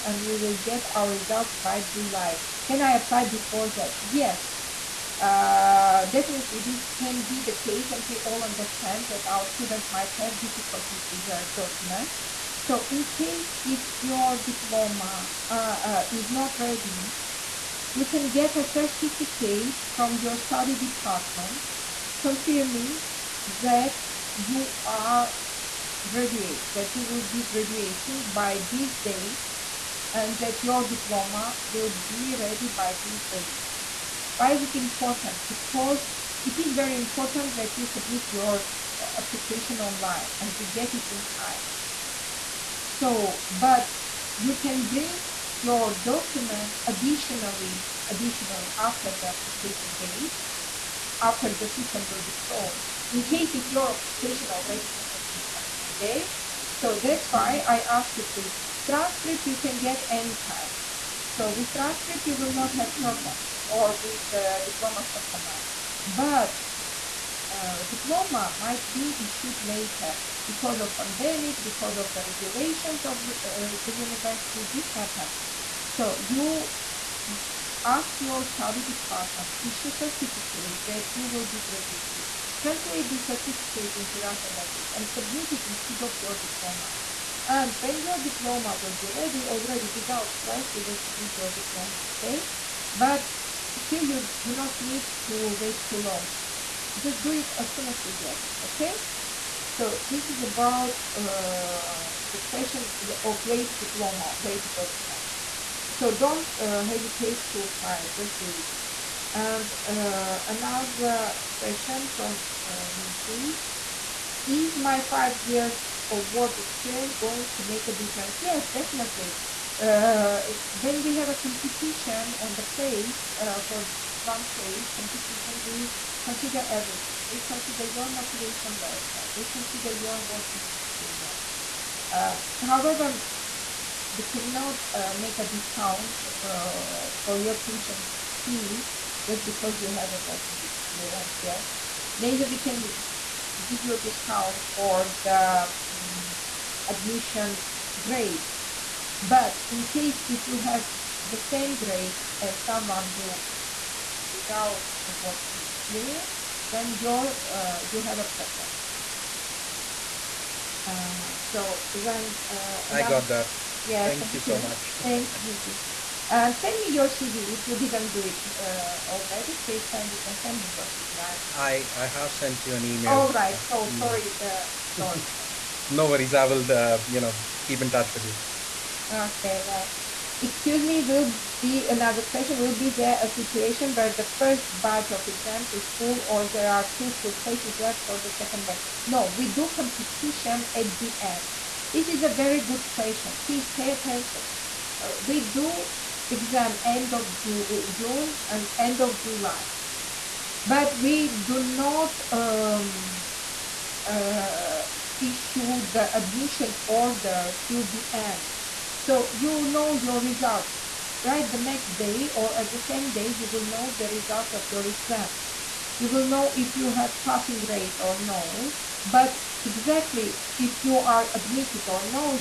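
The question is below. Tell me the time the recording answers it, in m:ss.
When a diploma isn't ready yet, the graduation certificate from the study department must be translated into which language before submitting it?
1:24.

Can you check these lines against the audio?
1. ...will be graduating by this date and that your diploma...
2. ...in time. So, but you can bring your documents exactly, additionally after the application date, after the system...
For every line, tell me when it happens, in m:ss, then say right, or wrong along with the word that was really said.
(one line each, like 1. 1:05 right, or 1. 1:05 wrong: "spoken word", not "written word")
1. 0:27 right
2. 0:41 wrong: "additionally", not "exactly".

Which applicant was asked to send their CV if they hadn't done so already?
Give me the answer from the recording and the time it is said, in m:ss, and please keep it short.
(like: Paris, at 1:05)
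Vicky, at 2:45.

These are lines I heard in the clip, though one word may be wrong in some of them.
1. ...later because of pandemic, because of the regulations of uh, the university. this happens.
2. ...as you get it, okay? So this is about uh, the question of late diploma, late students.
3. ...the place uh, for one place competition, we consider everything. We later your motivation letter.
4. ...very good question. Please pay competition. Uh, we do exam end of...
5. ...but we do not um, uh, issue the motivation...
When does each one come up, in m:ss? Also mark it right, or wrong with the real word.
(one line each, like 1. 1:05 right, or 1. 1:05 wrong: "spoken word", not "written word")
1. 1:09 right
2. 1:37 wrong: "documents", not "students"
3. 2:02 wrong: "consider", not "later"
4. 3:12 wrong: "attention", not "competition"
5. 3:20 wrong: "admission", not "motivation".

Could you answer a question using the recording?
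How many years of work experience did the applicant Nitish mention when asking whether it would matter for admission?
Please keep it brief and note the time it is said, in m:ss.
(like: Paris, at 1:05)
5, at 1:55.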